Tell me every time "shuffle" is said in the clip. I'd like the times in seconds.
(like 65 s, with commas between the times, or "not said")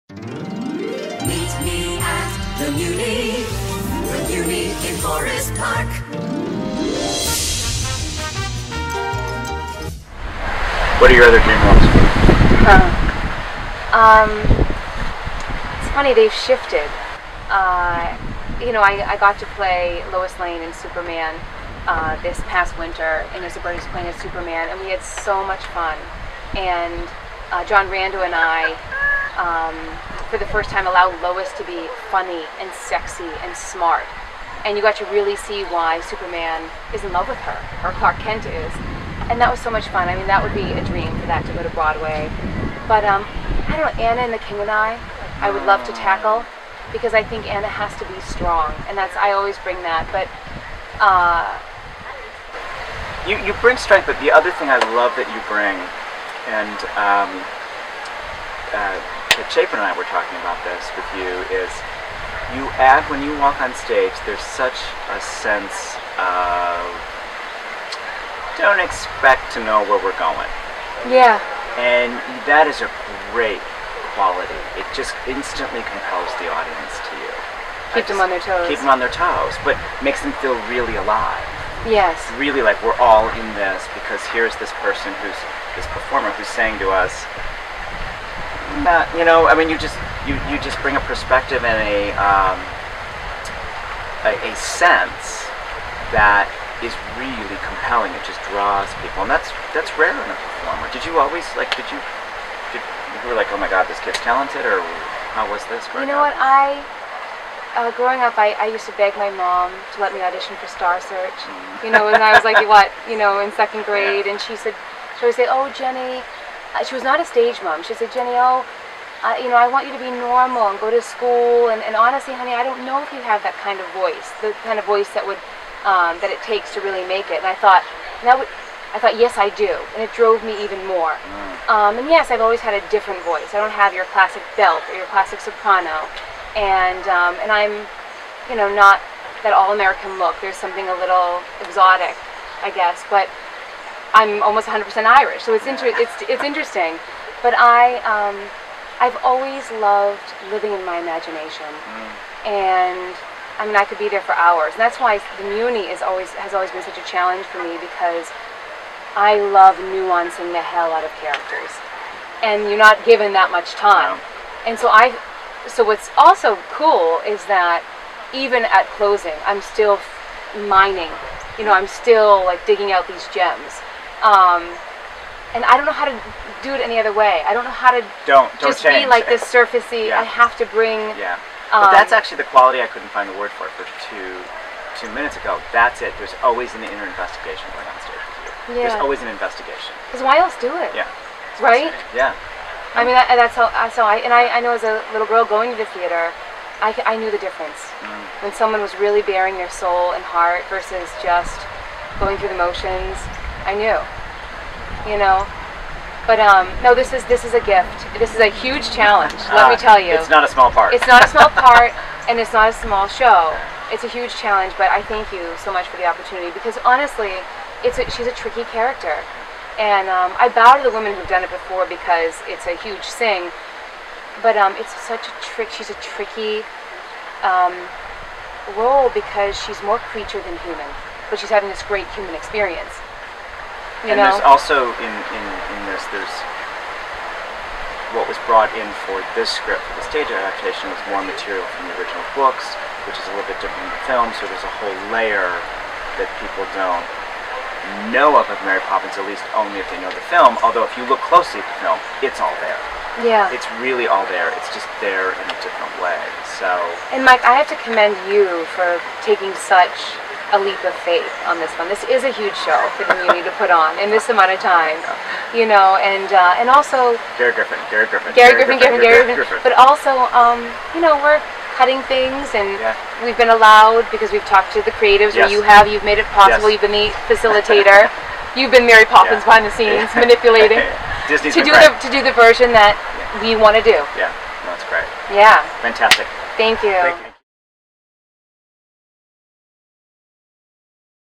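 not said.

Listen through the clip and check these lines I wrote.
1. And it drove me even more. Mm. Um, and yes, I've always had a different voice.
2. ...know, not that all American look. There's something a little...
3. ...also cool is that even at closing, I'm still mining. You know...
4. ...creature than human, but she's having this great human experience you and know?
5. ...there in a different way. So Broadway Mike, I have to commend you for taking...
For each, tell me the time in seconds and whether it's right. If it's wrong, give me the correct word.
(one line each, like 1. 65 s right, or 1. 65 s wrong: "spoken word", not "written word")
1. 129 s right
2. 138 s right
3. 166 s right
4. 230 s right
5. 254 s wrong: "And", not "Broadway".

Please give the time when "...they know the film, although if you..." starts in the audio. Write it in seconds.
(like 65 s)
249 s.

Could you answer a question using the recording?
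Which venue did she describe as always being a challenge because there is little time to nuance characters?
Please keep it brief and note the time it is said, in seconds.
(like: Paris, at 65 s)
the Muny, at 155 s.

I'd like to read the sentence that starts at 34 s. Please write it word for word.
And you got to really see why Superman is in love with her, or Clark Kent is.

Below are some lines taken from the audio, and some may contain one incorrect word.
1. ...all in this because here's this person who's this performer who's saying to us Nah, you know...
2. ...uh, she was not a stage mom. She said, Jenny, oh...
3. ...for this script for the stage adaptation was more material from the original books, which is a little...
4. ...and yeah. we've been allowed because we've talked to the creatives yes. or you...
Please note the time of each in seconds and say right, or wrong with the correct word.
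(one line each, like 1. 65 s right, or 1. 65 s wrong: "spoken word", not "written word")
1. 82 s right
2. 116 s right
3. 239 s right
4. 272 s right.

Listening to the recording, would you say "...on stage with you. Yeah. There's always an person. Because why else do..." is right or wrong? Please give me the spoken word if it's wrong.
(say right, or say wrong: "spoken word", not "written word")
wrong: "investigation", not "person".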